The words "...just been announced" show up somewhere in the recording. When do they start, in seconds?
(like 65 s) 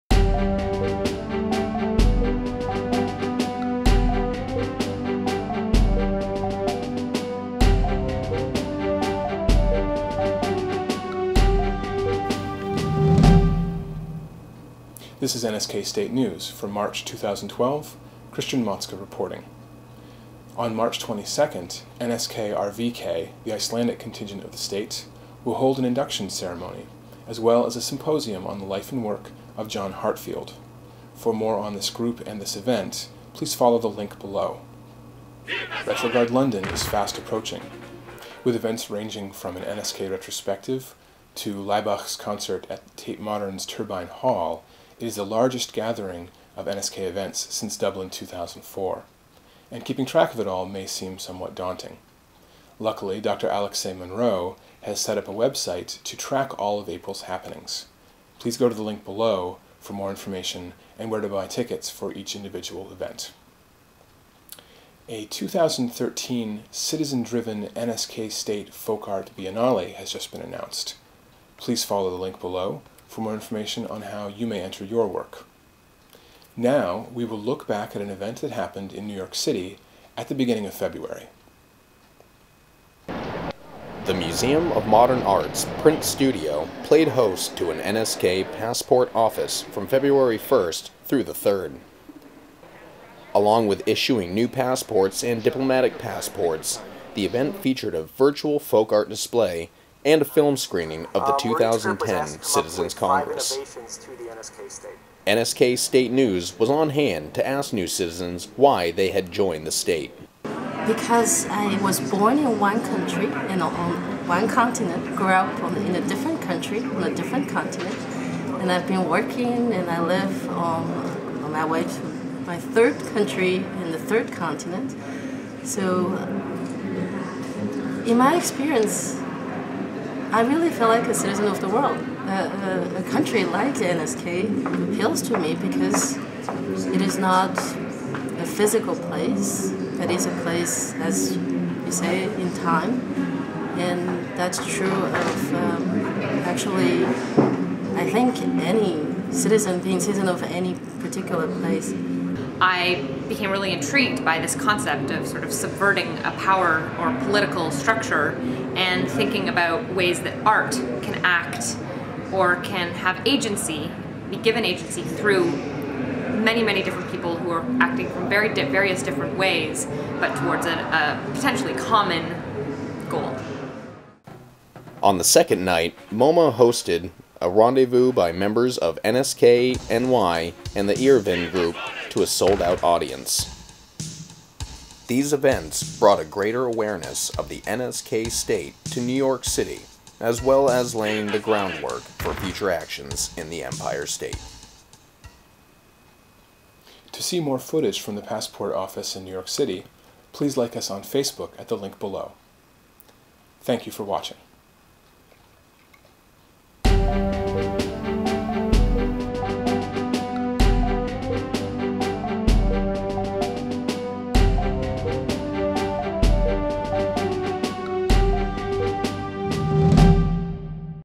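70 s.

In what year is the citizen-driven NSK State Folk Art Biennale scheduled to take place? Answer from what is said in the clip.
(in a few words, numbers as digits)
2013.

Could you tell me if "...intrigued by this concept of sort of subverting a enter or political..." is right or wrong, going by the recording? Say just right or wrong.
wrong.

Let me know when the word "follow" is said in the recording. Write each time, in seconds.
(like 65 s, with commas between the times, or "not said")
33 s, 71 s.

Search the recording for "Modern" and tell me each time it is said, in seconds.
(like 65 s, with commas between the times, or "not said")
43 s, 84 s.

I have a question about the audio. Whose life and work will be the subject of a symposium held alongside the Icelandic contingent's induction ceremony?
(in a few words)
John Heartfield.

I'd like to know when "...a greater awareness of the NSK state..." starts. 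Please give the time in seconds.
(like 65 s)
186 s.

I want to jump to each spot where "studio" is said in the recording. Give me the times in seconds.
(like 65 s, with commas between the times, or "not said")
86 s.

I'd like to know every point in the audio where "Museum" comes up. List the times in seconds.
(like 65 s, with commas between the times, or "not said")
84 s.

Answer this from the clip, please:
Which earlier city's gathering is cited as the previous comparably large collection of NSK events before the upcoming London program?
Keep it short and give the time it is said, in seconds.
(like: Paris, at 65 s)
Dublin, at 47 s.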